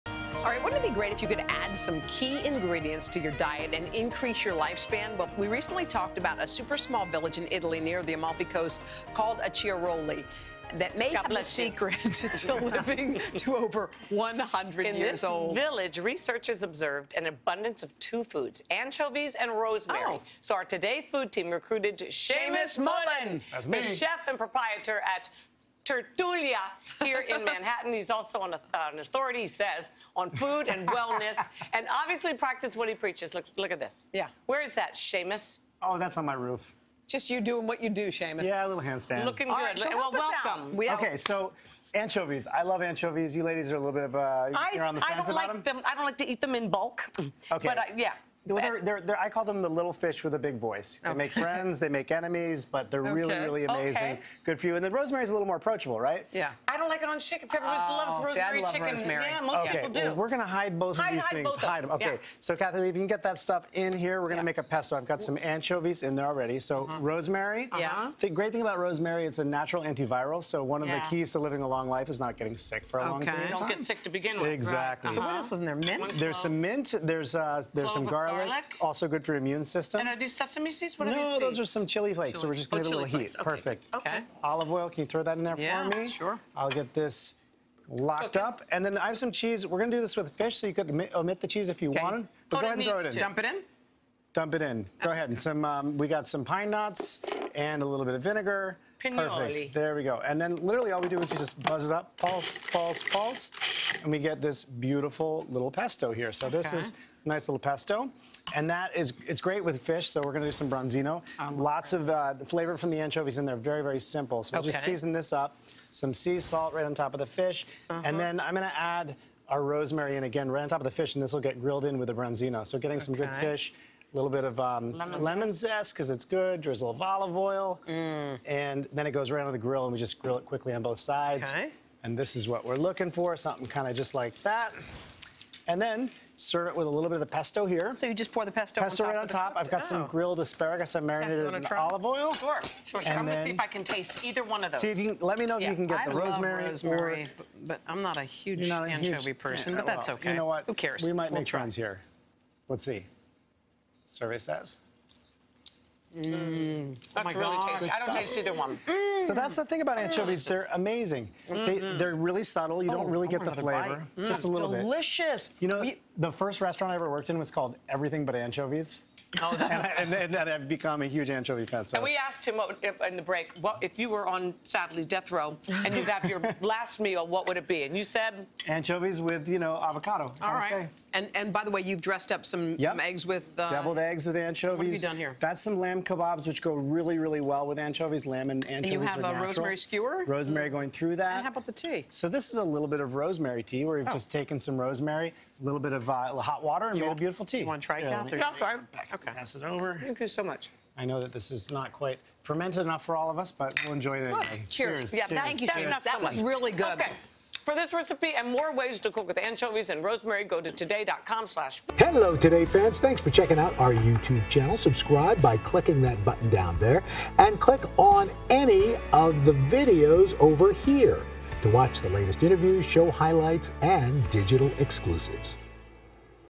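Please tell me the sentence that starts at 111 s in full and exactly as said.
Um, Lots of uh, the flavor from the anchovies in there, very, very simple.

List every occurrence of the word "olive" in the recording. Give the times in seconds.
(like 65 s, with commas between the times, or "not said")
84 s, 127 s, 141 s.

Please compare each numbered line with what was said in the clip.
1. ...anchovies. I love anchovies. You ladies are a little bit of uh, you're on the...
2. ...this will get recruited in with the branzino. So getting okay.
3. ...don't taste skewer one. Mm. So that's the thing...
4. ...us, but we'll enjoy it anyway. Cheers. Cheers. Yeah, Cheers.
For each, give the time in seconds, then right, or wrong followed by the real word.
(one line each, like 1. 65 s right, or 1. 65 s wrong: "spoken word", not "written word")
1. 41 s right
2. 121 s wrong: "grilled", not "recruited"
3. 157 s wrong: "either", not "skewer"
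4. 203 s right.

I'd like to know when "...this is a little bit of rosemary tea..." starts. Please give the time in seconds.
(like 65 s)
192 s.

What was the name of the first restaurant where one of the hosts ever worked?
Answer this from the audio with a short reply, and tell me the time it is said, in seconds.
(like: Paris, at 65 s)
Everything But Anchovies, at 167 s.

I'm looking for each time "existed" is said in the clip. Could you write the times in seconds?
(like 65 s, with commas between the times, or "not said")
not said.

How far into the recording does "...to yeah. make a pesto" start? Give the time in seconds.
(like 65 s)
64 s.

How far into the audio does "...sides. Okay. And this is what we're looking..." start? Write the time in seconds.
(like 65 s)
130 s.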